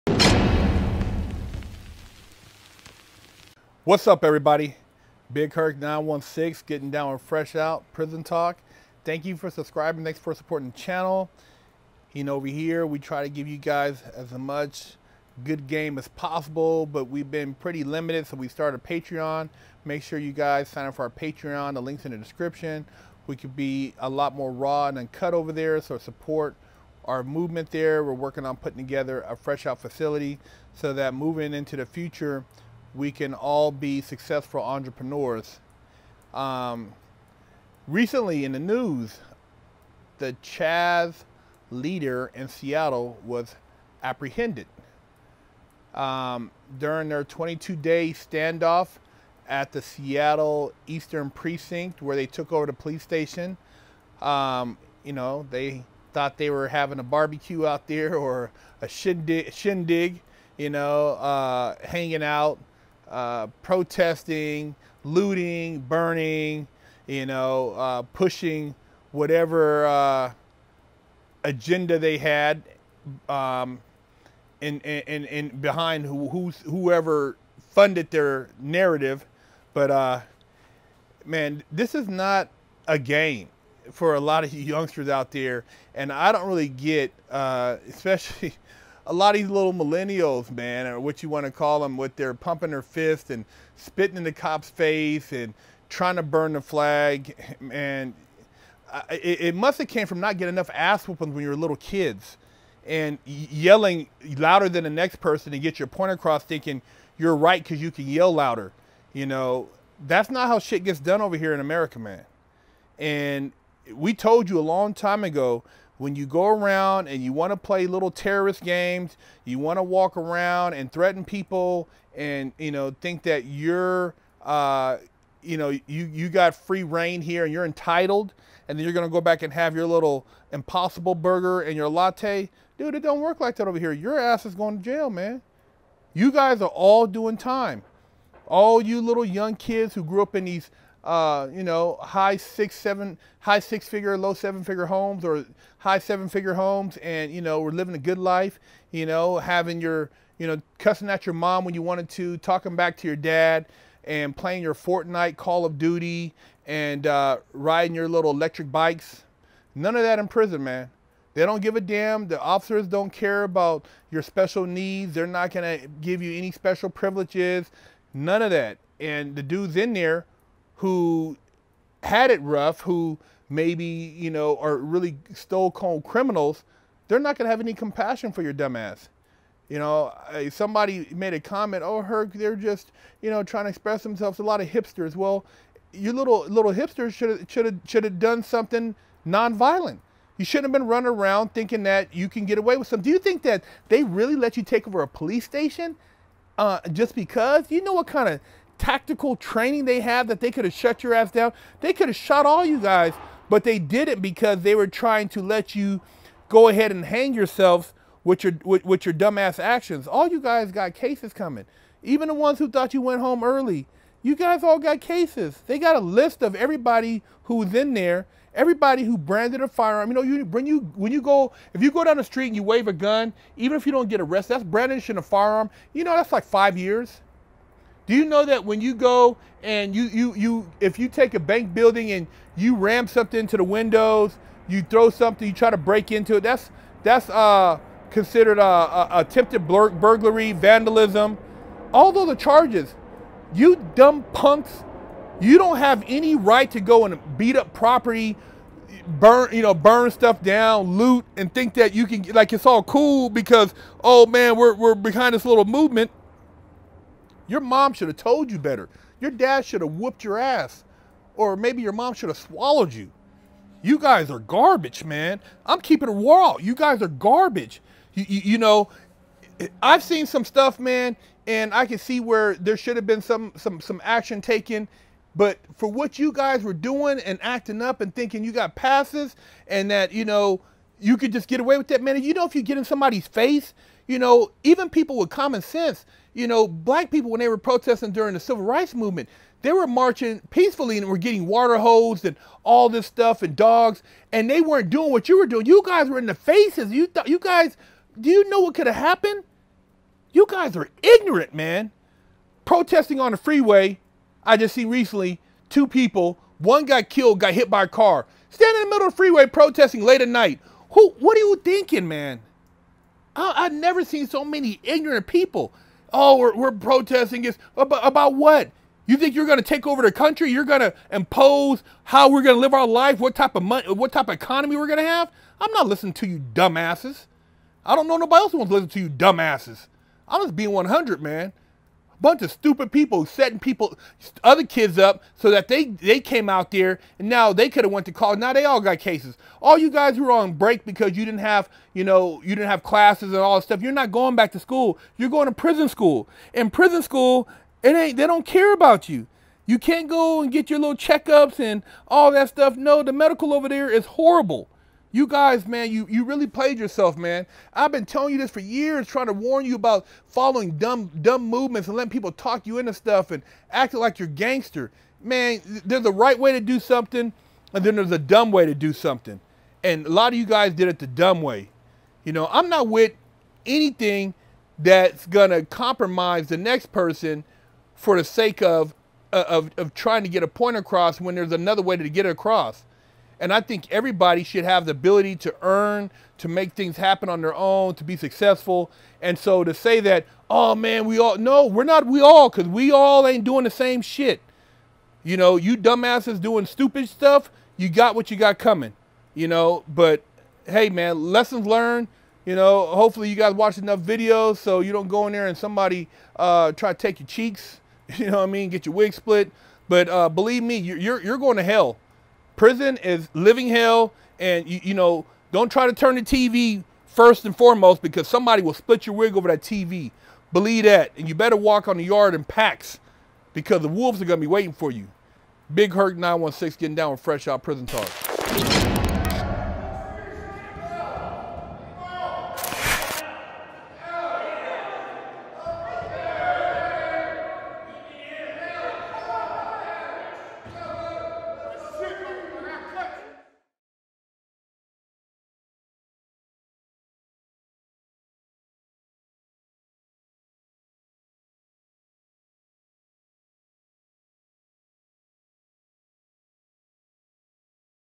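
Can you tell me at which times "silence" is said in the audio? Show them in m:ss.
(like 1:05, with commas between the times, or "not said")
not said.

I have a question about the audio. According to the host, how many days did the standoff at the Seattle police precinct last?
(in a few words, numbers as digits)
22.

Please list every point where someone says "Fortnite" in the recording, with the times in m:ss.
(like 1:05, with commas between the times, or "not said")
2:34.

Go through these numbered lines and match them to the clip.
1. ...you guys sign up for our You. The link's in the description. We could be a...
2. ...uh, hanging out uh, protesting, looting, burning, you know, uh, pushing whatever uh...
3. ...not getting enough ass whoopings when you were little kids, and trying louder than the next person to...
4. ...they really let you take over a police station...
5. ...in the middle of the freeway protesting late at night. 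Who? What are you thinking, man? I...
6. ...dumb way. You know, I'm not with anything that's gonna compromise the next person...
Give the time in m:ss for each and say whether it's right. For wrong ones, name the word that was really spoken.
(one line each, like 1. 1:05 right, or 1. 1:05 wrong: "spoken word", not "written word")
1. 0:20 wrong: "Patreon", not "You"
2. 1:01 right
3. 1:40 wrong: "yelling", not "trying"
4. 3:13 right
5. 5:08 right
6. 6:11 right.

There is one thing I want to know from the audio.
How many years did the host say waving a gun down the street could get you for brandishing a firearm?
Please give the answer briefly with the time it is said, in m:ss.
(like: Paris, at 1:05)
5, at 3:46.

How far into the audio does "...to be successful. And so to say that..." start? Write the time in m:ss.
6:27.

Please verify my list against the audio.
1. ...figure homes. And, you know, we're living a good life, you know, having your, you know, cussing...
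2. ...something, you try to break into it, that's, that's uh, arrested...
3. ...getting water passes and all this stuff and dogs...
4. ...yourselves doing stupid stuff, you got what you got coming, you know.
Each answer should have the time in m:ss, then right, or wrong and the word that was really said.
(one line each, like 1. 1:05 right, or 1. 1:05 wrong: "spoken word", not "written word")
1. 2:26 right
2. 3:55 wrong: "considered", not "arrested"
3. 4:51 wrong: "hoses", not "passes"
4. 6:35 wrong: "dumbasses", not "yourselves".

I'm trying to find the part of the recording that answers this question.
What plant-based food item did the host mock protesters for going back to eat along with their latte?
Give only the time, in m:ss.
2:10.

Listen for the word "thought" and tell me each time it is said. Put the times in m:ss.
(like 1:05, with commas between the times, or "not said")
0:56, 3:32, 4:57.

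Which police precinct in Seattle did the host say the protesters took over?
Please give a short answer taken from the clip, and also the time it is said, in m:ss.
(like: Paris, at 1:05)
Eastern Precinct, at 0:50.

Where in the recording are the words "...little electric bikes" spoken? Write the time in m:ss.
2:38.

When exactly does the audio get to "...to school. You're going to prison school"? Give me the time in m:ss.
5:44.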